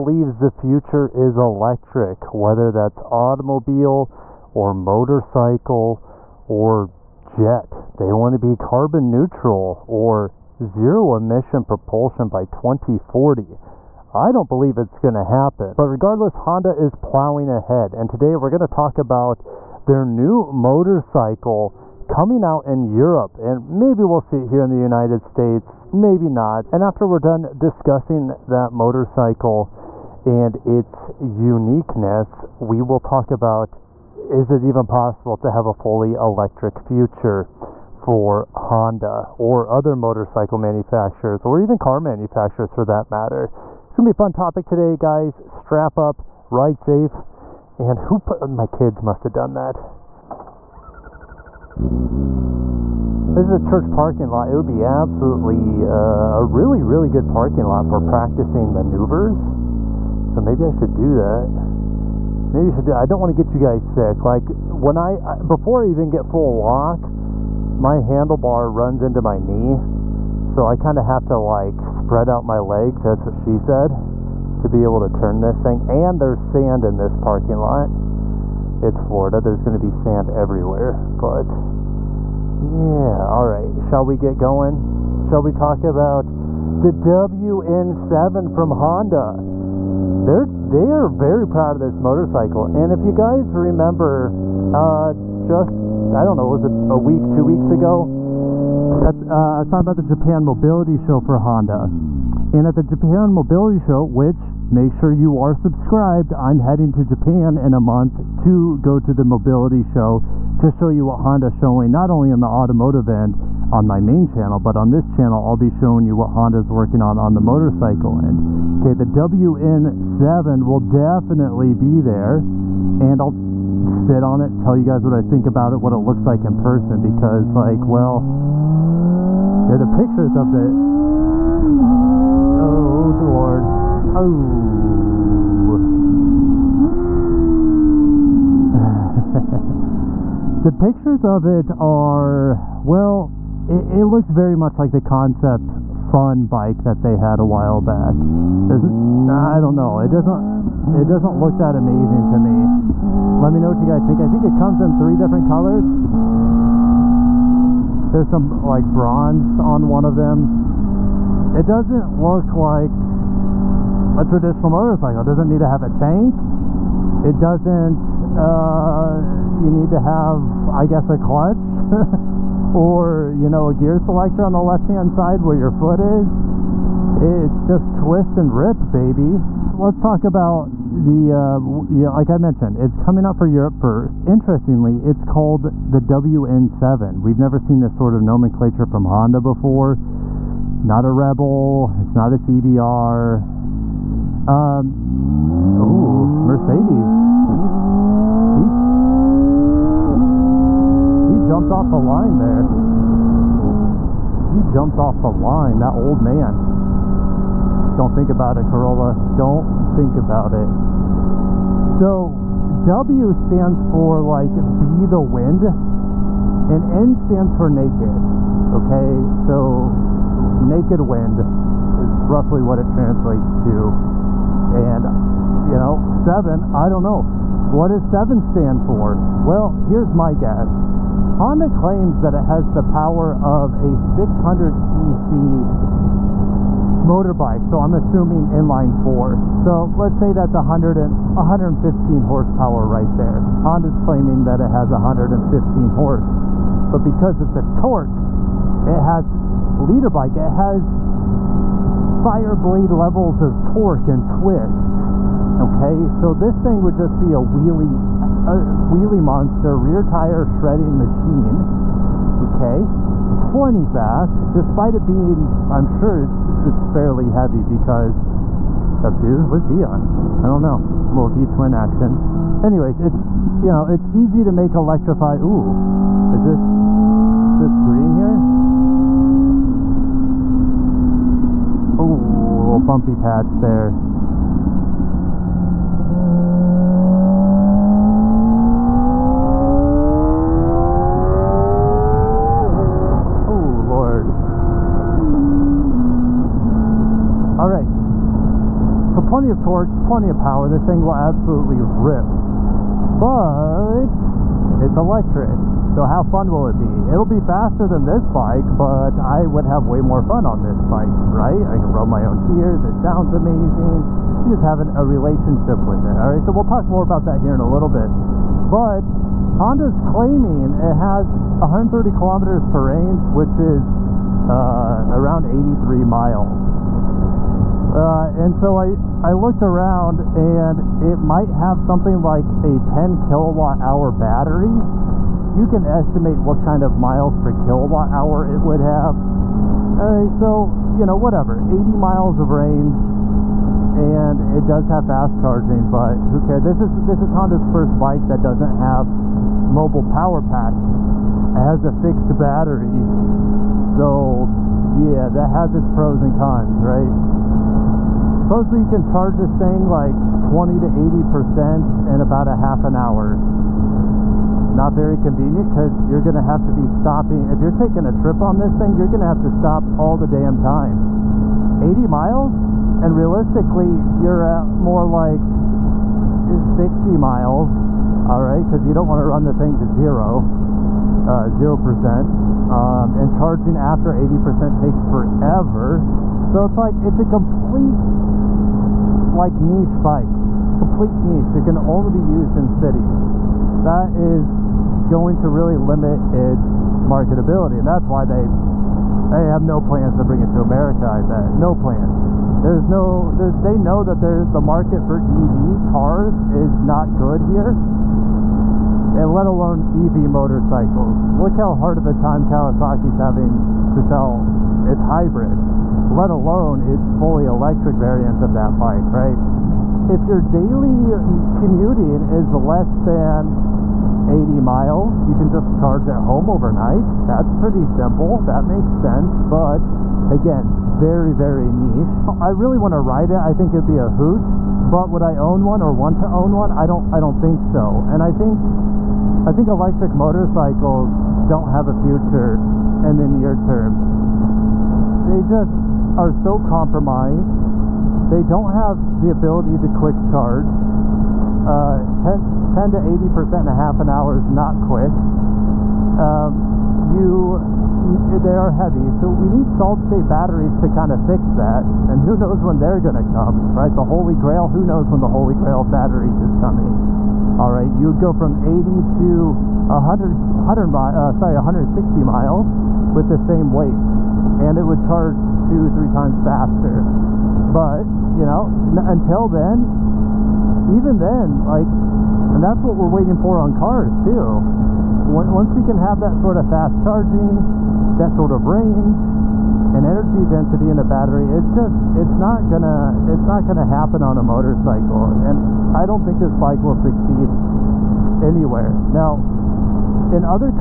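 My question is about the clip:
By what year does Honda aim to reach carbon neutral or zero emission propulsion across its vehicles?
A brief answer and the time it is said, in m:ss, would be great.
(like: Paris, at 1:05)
2040, at 0:12.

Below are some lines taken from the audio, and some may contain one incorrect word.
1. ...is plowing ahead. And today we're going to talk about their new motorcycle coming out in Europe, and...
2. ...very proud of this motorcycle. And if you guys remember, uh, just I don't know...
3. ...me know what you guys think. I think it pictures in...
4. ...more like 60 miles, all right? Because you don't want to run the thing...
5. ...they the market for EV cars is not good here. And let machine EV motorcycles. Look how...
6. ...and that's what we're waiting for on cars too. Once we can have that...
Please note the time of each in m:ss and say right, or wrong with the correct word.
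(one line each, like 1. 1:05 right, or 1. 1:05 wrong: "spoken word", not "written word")
1. 0:16 right
2. 1:31 right
3. 2:33 wrong: "comes", not "pictures"
4. 6:14 right
5. 6:44 wrong: "alone", not "machine"
6. 8:02 right.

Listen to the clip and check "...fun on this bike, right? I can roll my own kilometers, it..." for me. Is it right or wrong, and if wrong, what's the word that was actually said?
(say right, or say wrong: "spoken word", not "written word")
wrong: "gears", not "kilometers".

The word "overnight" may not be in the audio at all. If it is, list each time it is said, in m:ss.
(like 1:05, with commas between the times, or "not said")
7:06.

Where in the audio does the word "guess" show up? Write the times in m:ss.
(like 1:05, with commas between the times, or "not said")
2:50, 3:50.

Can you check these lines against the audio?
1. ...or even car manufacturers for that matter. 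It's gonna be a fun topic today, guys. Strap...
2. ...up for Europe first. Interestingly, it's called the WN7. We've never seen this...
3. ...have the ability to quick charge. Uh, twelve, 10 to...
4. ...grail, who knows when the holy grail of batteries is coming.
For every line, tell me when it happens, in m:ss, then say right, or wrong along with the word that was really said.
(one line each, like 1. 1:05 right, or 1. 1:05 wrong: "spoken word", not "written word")
1. 0:41 right
2. 3:03 right
3. 7:28 wrong: "ten", not "twelve"
4. 7:44 right.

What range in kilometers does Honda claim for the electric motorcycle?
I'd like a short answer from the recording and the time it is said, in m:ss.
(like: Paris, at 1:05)
130 kilometers, at 5:21.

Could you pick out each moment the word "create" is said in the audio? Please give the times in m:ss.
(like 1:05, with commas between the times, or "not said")
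not said.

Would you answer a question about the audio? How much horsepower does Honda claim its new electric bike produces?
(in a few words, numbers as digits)
115.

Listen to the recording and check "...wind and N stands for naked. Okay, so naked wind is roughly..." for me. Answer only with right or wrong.
right.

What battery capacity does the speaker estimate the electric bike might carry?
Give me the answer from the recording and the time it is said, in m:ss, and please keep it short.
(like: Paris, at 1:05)
10 kilowatt hour, at 5:32.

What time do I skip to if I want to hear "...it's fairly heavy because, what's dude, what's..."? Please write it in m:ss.
4:26.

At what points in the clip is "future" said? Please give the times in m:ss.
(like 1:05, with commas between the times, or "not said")
0:00, 0:36, 7:22.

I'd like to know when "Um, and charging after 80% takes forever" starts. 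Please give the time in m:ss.
6:22.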